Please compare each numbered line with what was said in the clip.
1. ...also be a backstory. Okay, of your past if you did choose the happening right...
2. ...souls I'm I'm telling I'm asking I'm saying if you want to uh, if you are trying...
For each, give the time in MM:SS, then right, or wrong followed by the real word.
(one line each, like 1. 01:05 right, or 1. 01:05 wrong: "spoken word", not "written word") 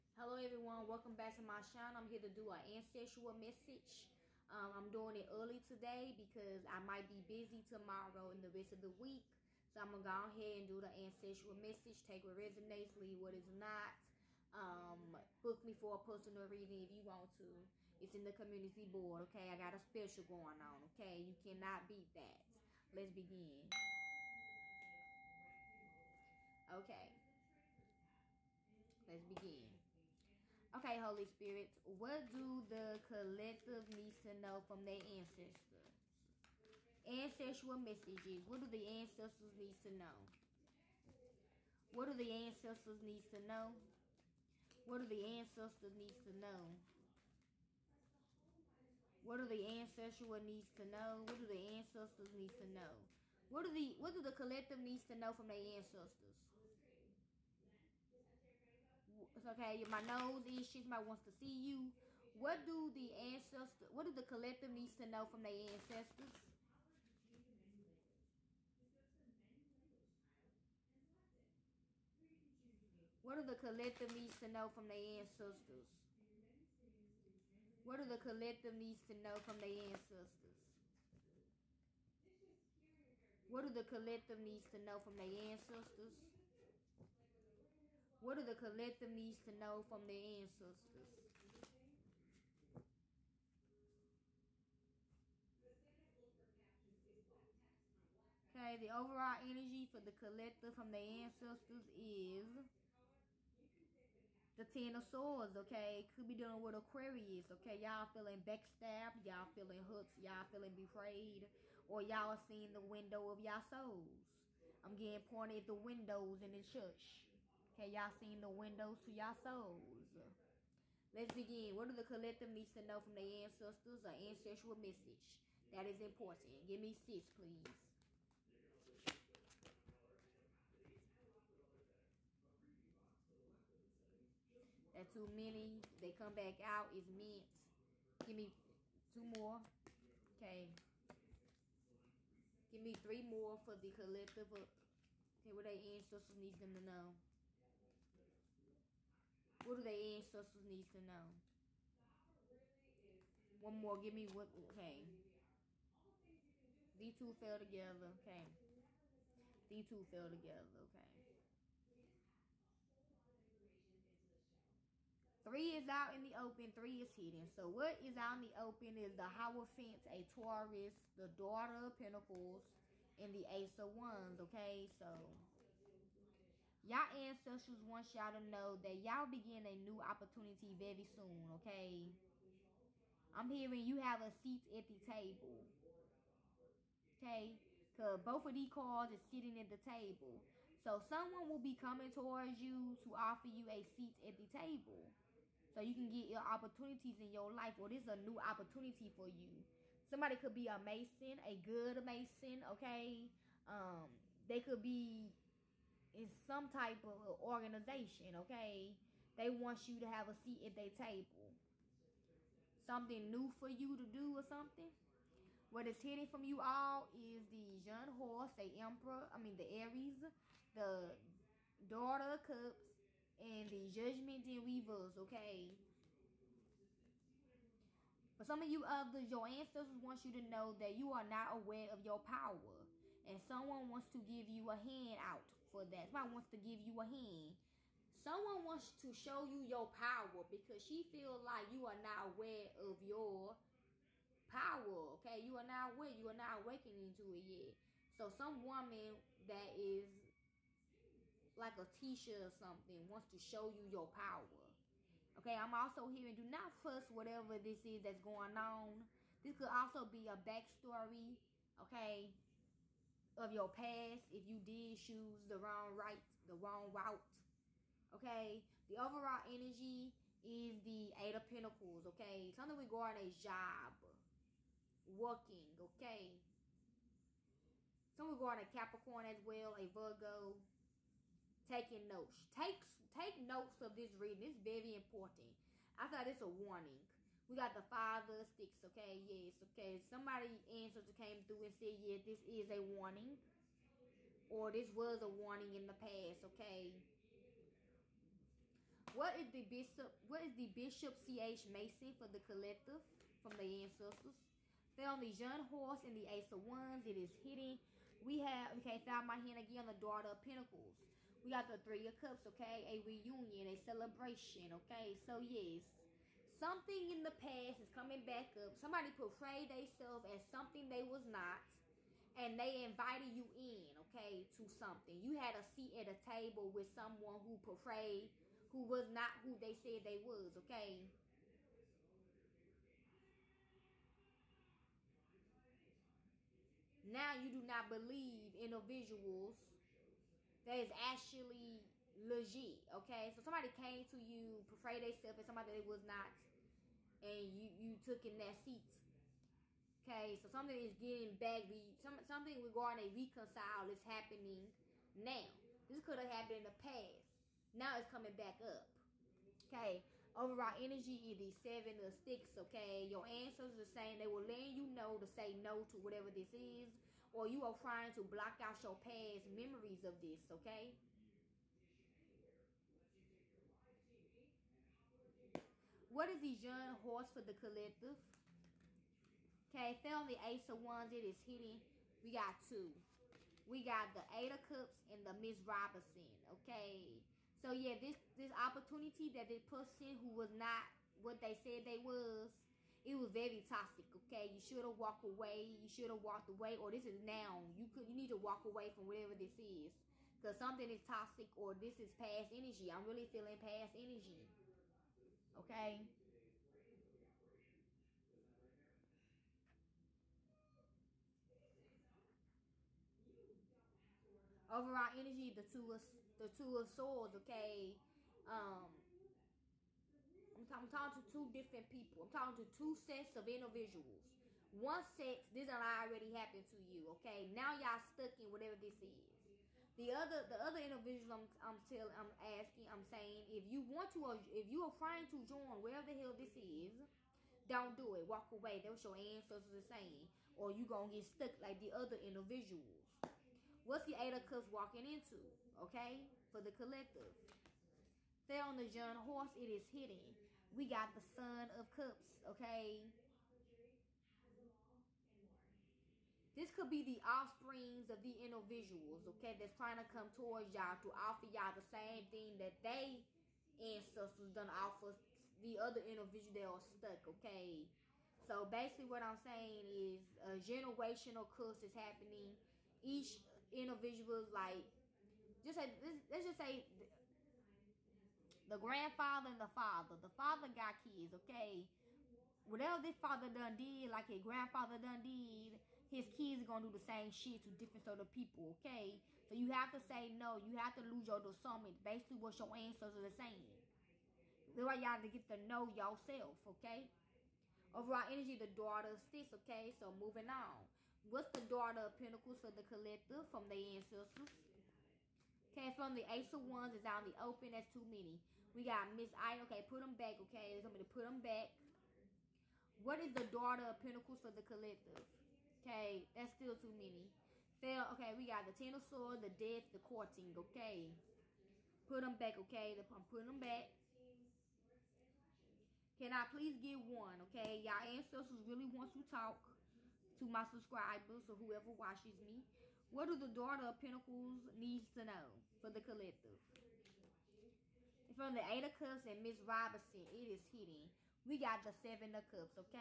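1. 04:19 wrong: "wrong", not "happening"
2. 07:10 wrong: "individuals", not "souls".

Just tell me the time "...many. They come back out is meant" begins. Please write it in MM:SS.
02:15.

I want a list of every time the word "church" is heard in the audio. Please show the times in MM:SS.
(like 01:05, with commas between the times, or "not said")
01:56.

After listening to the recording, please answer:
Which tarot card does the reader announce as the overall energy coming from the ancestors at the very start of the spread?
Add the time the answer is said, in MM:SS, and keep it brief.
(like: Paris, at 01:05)
Ten of Swords, at 01:44.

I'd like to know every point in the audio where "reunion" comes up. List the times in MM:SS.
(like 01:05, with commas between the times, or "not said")
05:13.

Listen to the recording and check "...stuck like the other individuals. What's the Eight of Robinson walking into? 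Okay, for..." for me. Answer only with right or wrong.
wrong.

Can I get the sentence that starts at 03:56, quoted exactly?
Somebody wants to give you a hand.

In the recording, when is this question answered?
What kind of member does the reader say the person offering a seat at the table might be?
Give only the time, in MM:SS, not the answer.
03:21.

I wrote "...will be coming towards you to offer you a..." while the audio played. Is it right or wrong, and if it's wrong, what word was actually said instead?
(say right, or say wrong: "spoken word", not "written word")
right.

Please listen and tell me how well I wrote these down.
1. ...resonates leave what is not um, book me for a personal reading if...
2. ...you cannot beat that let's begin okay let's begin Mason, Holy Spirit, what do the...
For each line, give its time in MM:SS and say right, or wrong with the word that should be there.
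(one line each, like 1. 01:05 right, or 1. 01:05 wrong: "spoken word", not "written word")
1. 00:12 right
2. 00:21 wrong: "Okay", not "Mason".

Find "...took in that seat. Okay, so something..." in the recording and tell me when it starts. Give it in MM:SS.
05:47.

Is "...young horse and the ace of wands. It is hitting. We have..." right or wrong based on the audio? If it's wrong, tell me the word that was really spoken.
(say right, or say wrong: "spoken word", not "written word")
right.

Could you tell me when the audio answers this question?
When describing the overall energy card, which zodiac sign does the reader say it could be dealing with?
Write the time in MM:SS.
01:46.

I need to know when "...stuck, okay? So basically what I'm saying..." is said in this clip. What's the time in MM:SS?
07:46.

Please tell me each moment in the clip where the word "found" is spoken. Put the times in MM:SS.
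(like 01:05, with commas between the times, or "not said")
05:04, 05:09, 06:20.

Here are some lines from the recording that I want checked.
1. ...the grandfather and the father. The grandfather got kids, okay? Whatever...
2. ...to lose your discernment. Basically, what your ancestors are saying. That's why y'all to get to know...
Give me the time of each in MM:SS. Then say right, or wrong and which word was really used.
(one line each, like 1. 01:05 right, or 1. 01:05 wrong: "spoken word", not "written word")
1. 07:58 wrong: "father", not "grandfather"
2. 08:10 right.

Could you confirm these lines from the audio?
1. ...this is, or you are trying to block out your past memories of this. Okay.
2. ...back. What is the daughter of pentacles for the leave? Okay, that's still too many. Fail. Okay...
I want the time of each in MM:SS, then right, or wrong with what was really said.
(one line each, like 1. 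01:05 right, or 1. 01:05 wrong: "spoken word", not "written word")
1. 06:06 right
2. 08:31 wrong: "collective", not "leave".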